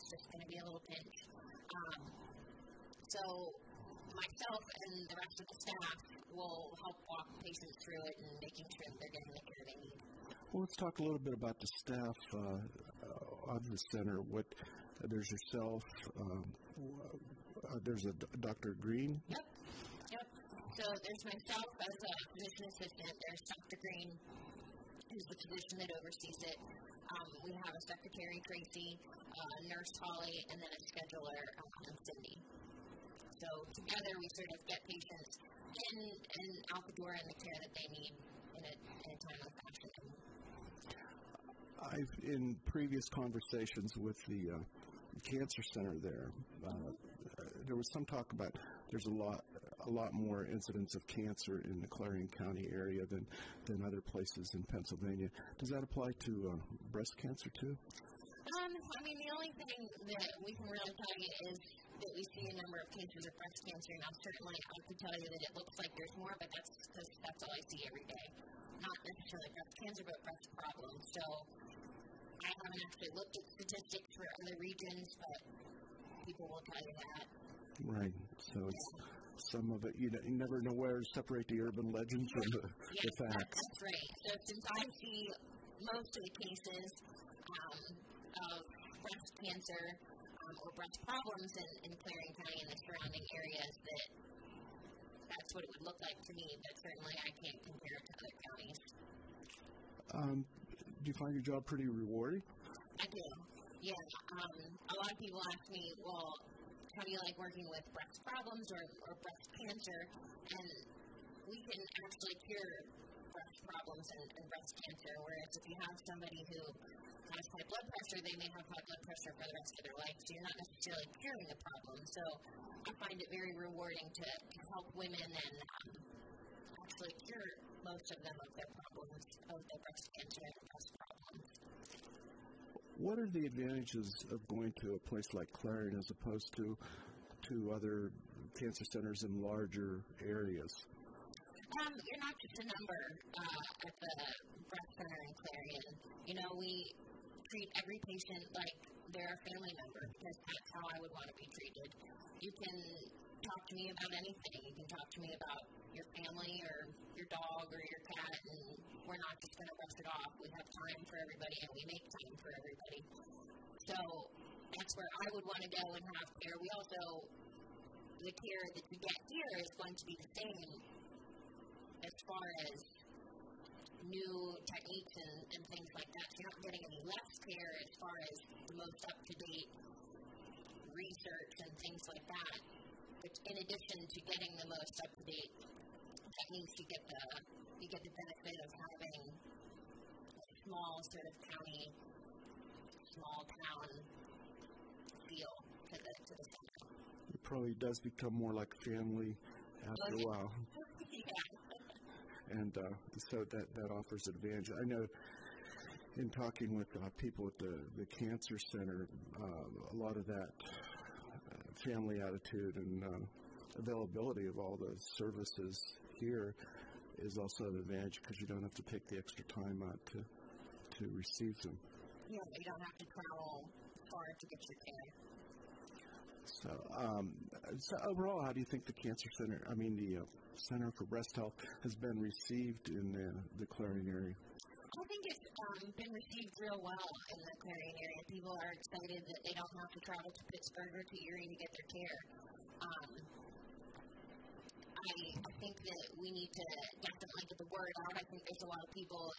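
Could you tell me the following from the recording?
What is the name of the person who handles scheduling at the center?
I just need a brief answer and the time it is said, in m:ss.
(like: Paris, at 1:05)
Cindy, at 0:32.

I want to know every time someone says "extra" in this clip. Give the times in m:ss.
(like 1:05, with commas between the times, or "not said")
3:39.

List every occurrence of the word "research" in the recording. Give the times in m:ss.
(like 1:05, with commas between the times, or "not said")
3:00.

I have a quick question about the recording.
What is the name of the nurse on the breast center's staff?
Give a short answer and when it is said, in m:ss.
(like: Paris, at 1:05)
Holly, at 0:30.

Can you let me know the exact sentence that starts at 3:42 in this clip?
Yeah, you don't have to travel far to get your care.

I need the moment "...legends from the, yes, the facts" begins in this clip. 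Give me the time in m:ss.
1:21.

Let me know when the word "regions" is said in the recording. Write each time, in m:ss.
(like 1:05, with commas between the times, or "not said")
1:14.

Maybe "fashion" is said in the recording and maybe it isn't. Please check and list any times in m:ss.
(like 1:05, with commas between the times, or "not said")
0:39.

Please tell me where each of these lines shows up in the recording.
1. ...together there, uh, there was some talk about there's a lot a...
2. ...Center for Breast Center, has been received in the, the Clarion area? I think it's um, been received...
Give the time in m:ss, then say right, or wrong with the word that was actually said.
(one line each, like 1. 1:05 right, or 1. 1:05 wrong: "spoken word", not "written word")
1. 0:45 wrong: "center", not "together"
2. 3:50 wrong: "Health", not "Center".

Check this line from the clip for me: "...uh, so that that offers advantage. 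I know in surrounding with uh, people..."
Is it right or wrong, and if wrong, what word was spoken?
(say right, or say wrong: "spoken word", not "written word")
wrong: "talking", not "surrounding".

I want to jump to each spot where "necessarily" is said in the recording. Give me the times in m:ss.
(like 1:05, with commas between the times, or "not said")
1:09, 2:00.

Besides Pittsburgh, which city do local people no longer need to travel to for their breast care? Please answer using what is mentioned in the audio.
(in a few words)
Erie.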